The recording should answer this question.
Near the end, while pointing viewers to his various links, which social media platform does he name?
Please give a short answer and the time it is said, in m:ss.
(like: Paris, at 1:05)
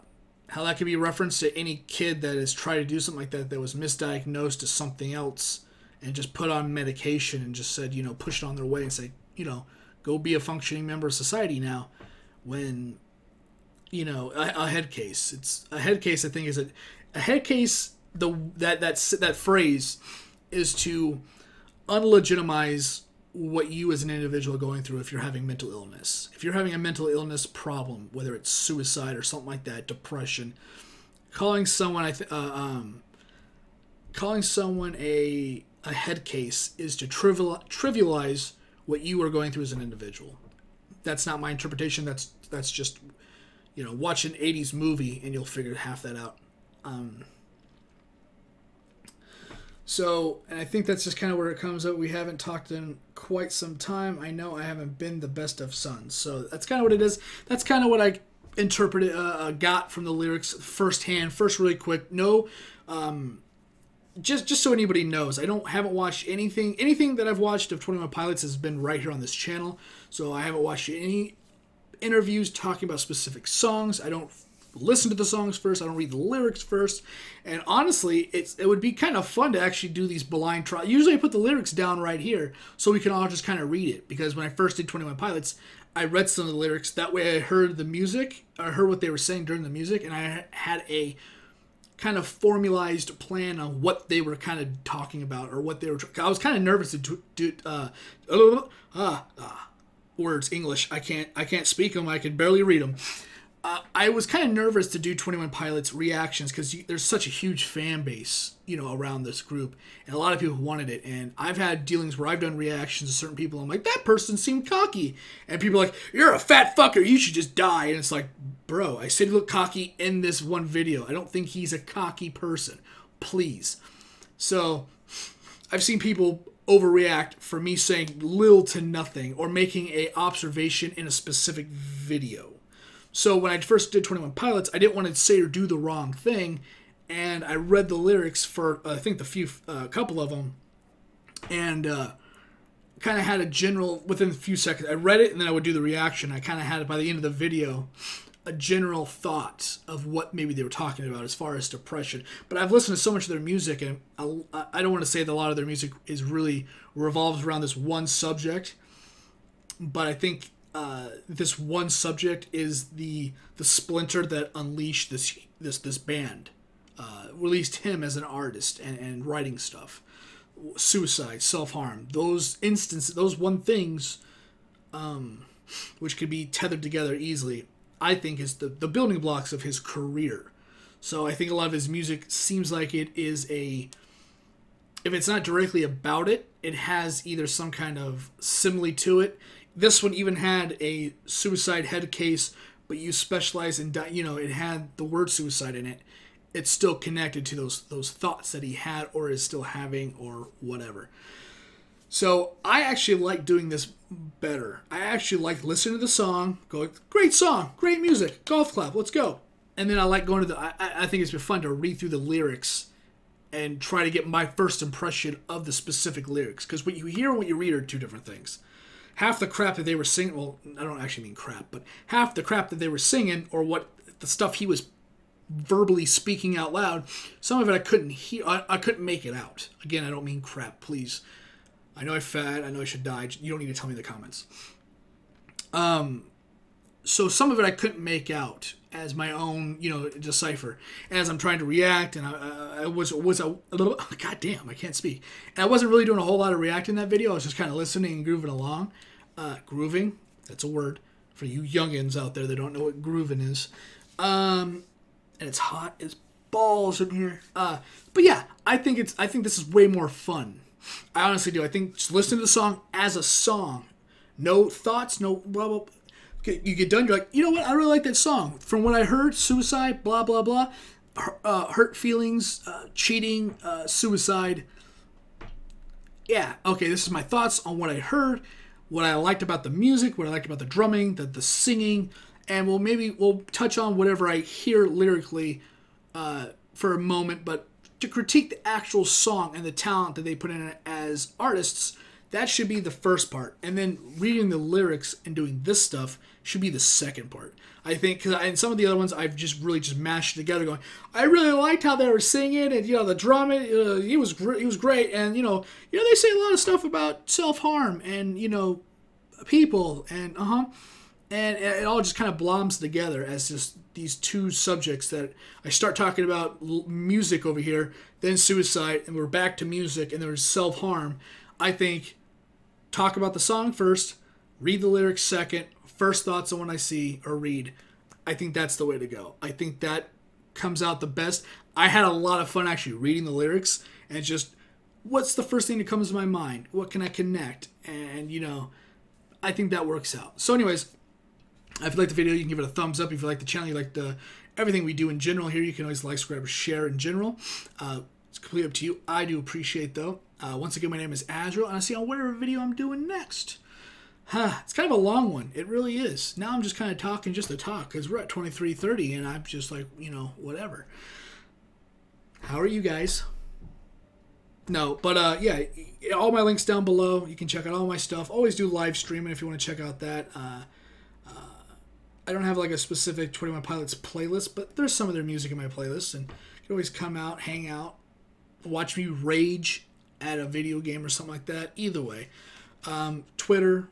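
Twitter, at 6:23.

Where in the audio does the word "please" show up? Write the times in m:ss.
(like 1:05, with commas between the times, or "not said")
2:03, 3:50.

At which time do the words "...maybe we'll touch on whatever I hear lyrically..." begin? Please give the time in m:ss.
4:42.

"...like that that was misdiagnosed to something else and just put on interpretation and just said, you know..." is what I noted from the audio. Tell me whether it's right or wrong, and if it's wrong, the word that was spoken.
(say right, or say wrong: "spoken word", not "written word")
wrong: "medication", not "interpretation".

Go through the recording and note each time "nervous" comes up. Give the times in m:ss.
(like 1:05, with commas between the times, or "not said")
1:36, 1:44.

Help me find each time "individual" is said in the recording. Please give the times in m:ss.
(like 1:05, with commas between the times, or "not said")
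0:24, 0:39.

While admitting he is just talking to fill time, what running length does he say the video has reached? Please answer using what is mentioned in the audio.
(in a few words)
23:30.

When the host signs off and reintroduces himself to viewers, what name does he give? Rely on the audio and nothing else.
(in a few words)
Azrael.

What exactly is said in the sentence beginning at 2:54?
Um, which could be tethered together easily, I think is the, the building blocks of his career.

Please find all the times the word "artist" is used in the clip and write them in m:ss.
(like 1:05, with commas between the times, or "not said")
2:48, 4:51.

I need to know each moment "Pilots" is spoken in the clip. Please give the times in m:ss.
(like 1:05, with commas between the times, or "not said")
1:08, 1:25, 1:45, 2:14, 6:13.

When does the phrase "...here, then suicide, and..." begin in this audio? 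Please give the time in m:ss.
5:17.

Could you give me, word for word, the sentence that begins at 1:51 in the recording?
And I've had dealings where I've done reactions to certain people.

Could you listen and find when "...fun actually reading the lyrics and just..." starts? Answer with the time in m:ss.
5:32.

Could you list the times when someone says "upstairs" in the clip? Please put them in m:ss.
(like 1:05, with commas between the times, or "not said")
not said.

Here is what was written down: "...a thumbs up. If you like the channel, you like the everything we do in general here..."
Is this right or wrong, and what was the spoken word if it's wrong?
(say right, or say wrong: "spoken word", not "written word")
right.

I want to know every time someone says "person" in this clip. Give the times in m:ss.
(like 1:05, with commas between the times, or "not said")
1:54, 2:02.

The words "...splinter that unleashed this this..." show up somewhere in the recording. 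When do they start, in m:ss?
2:43.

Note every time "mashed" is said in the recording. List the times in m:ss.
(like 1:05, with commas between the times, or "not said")
4:59.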